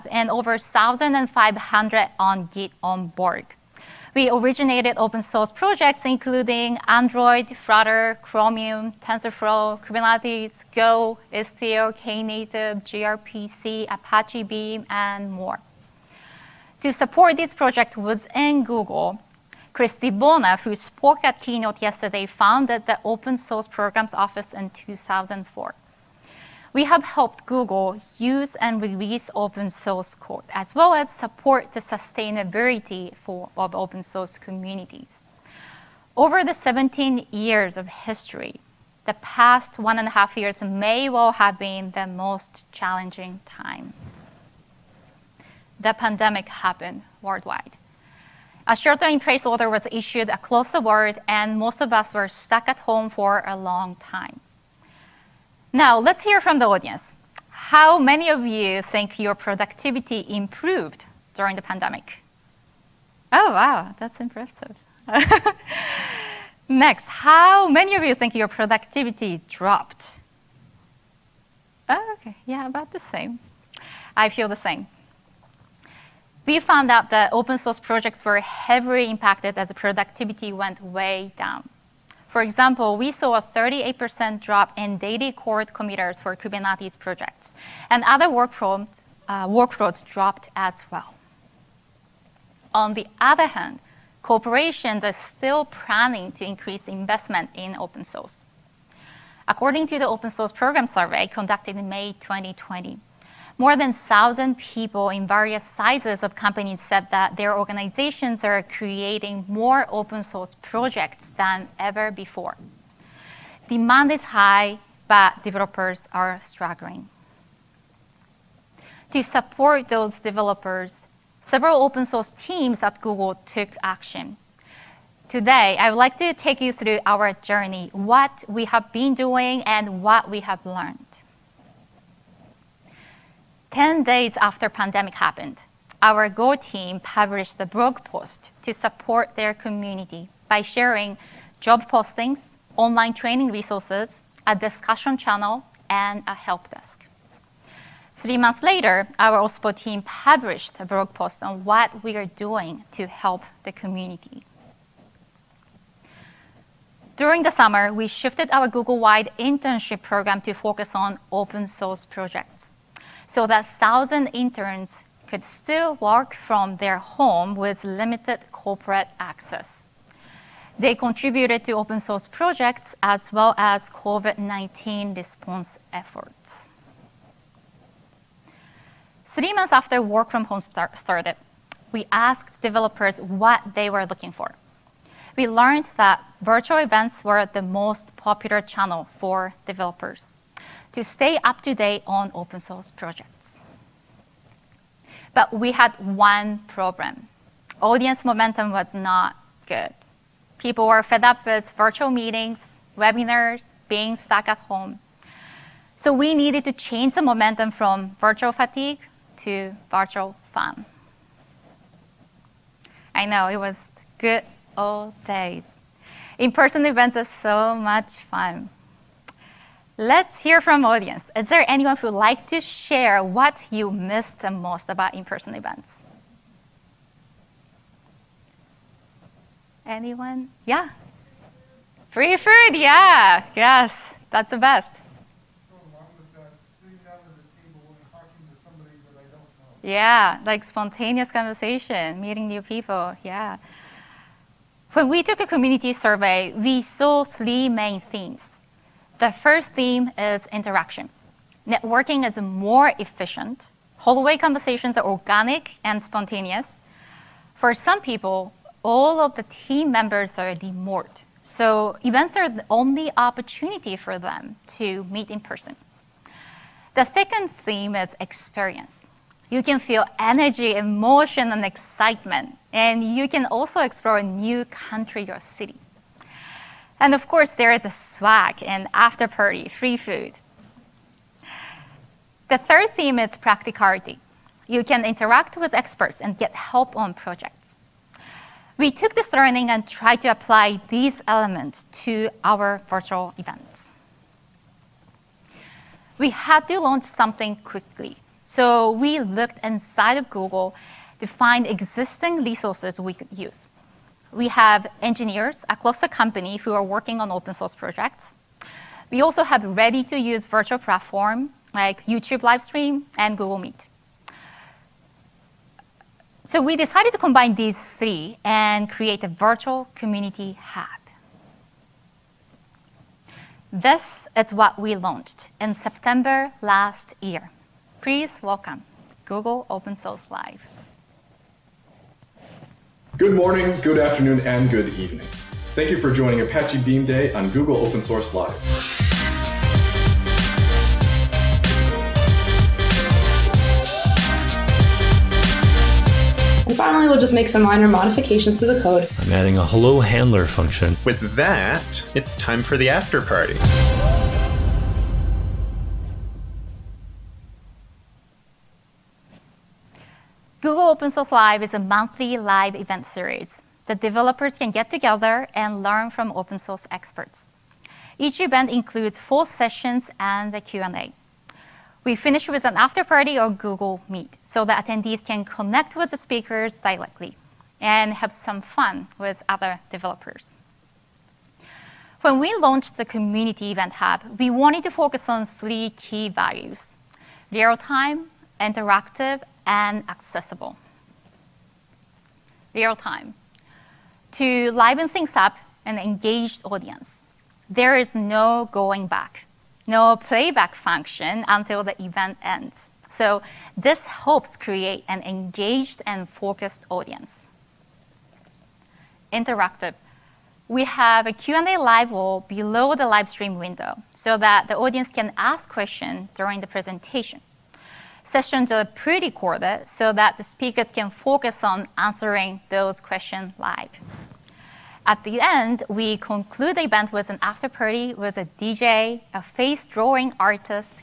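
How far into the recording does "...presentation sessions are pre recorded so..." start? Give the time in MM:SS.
06:56.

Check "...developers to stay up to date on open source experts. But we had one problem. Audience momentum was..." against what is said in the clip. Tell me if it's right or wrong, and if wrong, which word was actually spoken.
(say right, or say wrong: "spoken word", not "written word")
wrong: "projects", not "experts".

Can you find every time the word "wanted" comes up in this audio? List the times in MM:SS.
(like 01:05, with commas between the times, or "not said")
06:24.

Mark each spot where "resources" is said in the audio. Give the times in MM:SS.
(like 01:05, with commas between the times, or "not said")
02:23, 05:02.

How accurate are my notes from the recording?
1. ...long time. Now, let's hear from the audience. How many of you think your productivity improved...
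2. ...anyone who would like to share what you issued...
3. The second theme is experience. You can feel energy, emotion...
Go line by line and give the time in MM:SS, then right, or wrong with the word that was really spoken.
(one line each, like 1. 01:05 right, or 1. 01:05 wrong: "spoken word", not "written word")
1. 00:53 right
2. 03:41 wrong: "missed", not "issued"
3. 04:26 right.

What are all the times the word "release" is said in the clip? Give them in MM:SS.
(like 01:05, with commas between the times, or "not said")
00:28.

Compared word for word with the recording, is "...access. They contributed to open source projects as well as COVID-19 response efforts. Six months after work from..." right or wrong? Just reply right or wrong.
wrong.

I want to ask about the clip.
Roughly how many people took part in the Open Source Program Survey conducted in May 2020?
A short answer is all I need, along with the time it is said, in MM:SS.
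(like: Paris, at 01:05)
more than 1,000, at 01:43.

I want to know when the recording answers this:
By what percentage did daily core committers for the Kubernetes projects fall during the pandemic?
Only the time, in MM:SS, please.
01:23.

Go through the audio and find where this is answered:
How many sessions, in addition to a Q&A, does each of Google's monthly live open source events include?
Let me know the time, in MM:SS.
06:09.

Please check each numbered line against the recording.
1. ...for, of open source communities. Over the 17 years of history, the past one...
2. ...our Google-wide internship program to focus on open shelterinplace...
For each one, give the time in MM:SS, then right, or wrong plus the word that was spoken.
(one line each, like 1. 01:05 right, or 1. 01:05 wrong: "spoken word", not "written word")
1. 00:33 right
2. 02:38 wrong: "source", not "shelterinplace".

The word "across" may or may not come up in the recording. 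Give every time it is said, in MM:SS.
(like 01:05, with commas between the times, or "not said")
00:50, 05:05.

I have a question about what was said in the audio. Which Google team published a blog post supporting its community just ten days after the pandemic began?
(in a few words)
Go team.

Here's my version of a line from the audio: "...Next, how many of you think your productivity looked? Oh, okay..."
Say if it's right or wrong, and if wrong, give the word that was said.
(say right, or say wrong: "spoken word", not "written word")
wrong: "dropped", not "looked".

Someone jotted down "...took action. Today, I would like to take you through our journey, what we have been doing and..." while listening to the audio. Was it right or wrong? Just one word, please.
right.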